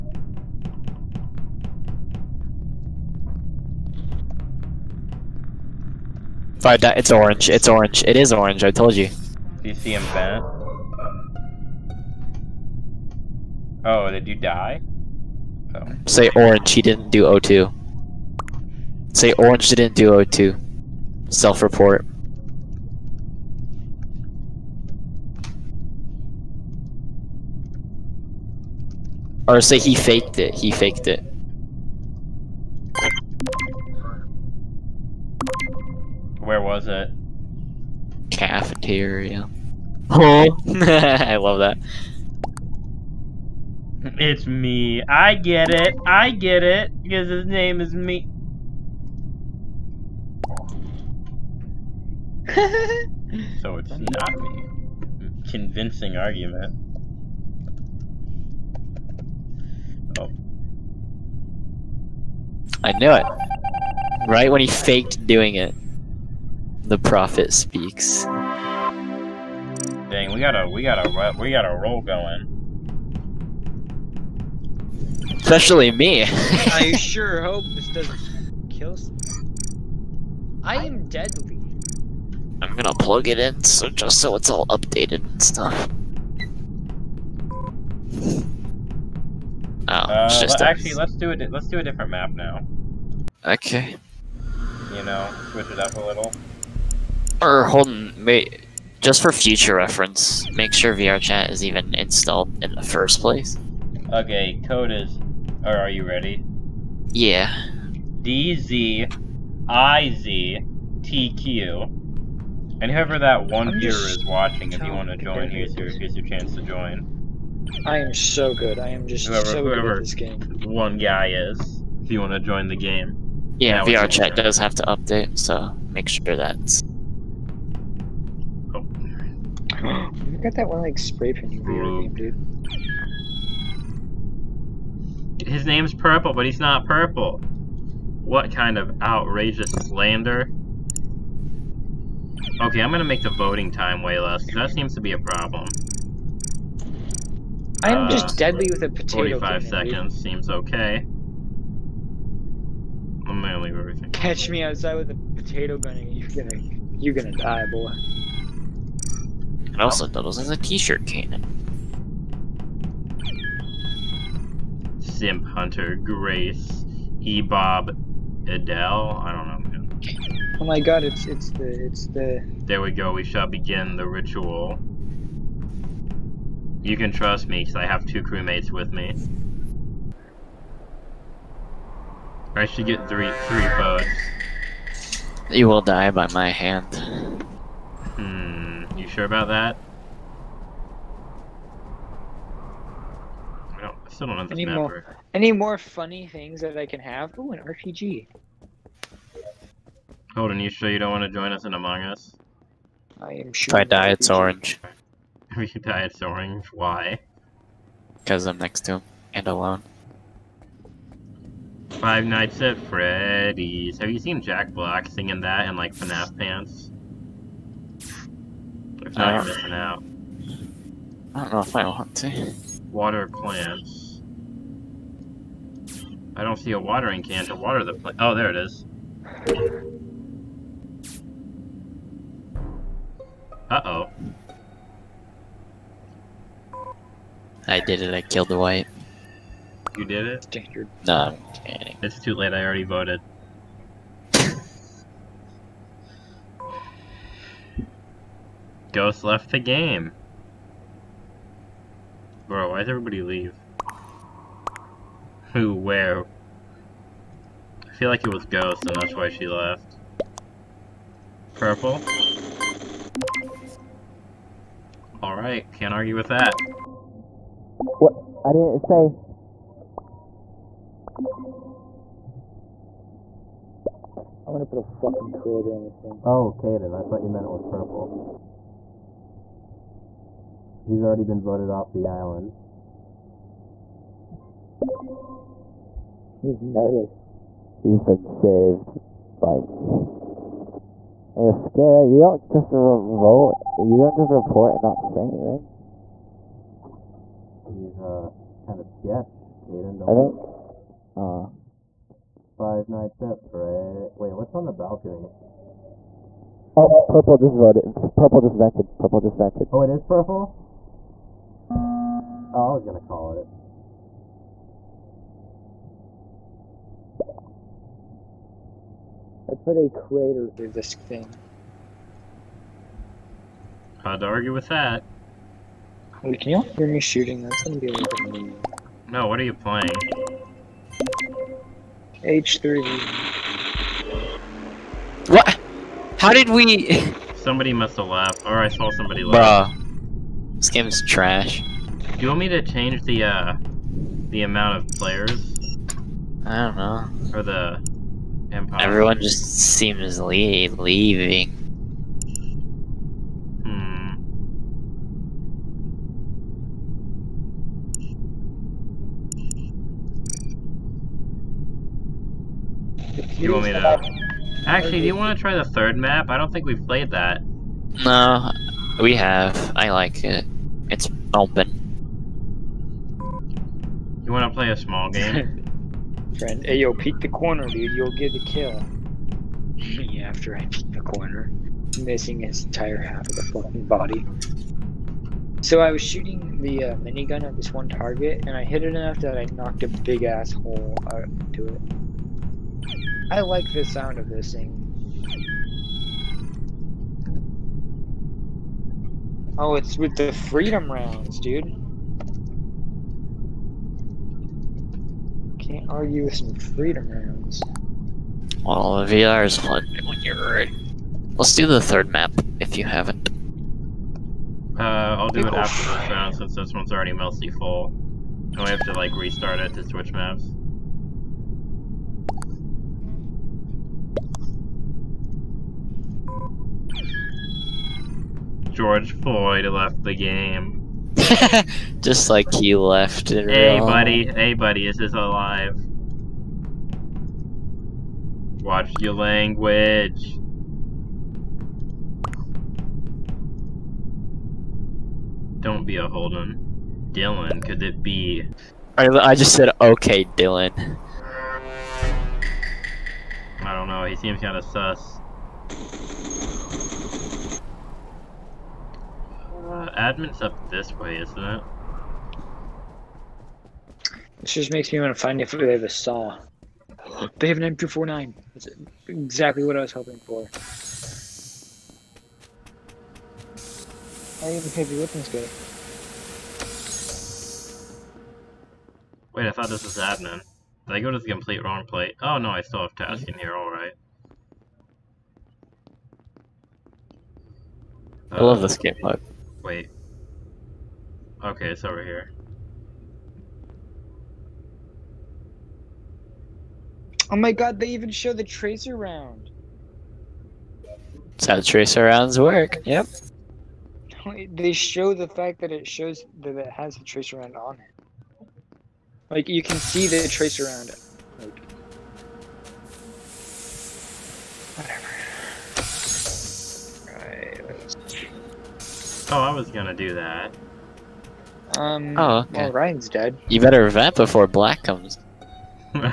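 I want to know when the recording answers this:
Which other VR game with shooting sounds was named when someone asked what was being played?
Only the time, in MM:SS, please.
05:32.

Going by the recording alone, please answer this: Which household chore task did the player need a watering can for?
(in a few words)
Water plants.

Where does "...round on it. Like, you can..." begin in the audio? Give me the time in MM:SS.
08:27.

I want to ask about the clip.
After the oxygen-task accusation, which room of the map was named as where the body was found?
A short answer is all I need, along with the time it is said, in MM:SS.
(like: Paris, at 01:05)
Cafeteria, at 00:38.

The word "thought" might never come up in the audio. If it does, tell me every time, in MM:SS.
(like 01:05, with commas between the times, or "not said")
04:37, 07:59.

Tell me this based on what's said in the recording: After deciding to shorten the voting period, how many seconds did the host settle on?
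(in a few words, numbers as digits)
45.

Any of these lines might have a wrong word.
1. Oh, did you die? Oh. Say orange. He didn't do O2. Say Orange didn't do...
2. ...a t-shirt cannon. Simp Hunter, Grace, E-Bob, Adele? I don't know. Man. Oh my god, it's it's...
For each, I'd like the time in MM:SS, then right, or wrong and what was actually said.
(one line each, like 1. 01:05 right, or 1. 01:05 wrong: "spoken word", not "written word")
1. 00:13 right
2. 02:40 right.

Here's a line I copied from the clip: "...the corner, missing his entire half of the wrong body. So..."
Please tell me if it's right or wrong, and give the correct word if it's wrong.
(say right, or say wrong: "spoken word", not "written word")
wrong: "fucking", not "wrong".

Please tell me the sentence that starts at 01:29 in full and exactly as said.
Oh, uh, just actually, let's do it.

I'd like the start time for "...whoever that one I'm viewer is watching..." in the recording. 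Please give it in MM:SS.
01:52.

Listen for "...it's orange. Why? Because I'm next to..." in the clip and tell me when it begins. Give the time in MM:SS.
03:26.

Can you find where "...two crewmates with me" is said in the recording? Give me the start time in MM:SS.
02:58.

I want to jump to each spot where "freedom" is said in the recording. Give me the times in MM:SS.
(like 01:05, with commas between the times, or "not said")
06:40, 06:46.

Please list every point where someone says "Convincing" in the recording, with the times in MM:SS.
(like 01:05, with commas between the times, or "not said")
00:55.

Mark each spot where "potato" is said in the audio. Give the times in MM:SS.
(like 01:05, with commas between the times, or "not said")
02:28, 02:35.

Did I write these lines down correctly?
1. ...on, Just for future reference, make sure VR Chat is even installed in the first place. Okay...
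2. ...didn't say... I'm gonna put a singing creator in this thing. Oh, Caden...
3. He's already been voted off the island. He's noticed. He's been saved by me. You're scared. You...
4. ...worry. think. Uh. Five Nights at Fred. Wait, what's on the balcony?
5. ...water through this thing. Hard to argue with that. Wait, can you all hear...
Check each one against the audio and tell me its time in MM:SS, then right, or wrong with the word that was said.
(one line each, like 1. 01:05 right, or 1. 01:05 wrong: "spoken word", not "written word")
1. 01:37 right
2. 04:28 wrong: "fucking", not "singing"
3. 04:40 right
4. 05:00 right
5. 05:19 wrong: "crater", not "water".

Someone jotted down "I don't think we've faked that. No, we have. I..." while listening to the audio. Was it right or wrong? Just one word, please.
wrong.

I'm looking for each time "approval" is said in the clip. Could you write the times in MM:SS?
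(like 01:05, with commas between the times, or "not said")
not said.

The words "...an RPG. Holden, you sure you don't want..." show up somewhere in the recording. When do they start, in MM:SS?
03:17.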